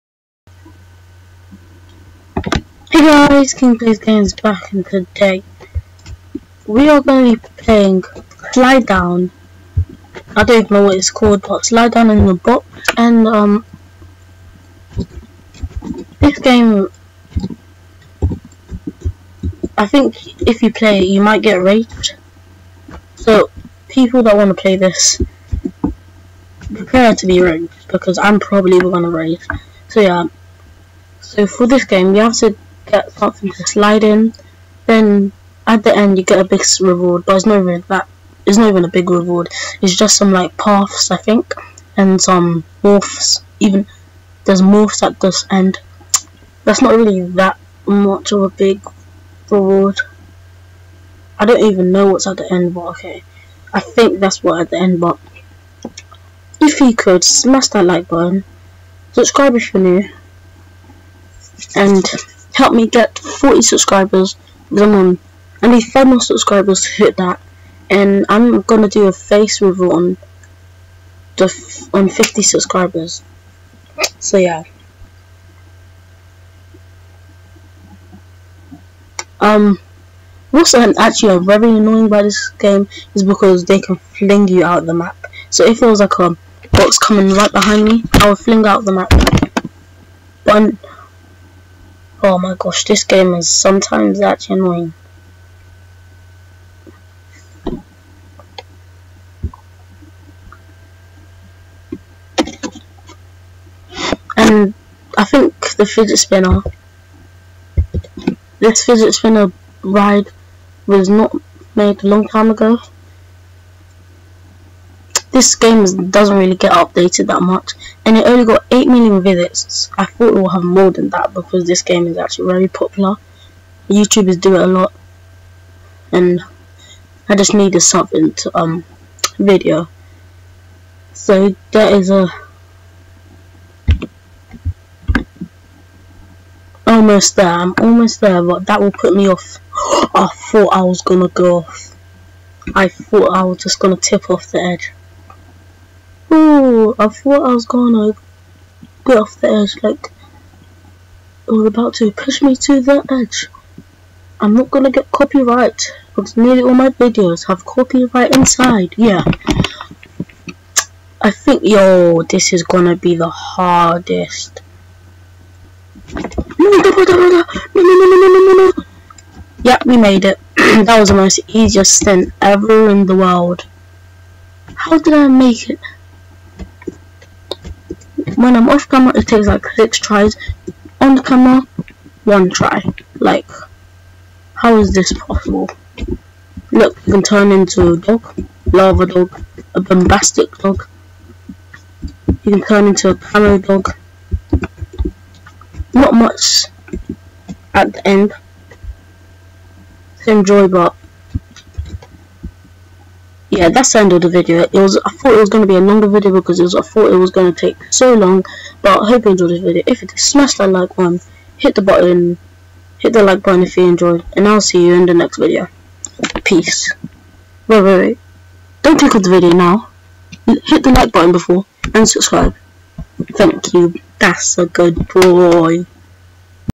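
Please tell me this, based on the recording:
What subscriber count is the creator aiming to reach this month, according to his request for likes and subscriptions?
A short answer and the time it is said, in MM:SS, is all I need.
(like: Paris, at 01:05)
40, at 01:03.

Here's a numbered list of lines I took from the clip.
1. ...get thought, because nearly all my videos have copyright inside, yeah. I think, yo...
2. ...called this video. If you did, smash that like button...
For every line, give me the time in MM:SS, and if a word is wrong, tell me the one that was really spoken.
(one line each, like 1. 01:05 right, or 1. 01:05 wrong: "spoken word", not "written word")
1. 02:34 wrong: "copyright", not "thought"
2. 03:29 wrong: "enjoyed", not "called".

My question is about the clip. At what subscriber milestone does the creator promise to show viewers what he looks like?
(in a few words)
50.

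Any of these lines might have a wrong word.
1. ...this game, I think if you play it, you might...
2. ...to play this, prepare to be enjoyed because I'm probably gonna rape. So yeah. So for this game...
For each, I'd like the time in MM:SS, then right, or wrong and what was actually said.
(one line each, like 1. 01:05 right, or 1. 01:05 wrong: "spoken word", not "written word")
1. 00:16 right
2. 00:24 wrong: "raped", not "enjoyed".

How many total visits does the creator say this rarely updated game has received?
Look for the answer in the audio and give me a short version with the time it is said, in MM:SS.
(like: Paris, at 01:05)
8 million, at 01:58.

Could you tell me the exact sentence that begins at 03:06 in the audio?
Look, you can turn into a dog, lava dog, a bombastic dog.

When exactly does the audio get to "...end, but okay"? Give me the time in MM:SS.
00:52.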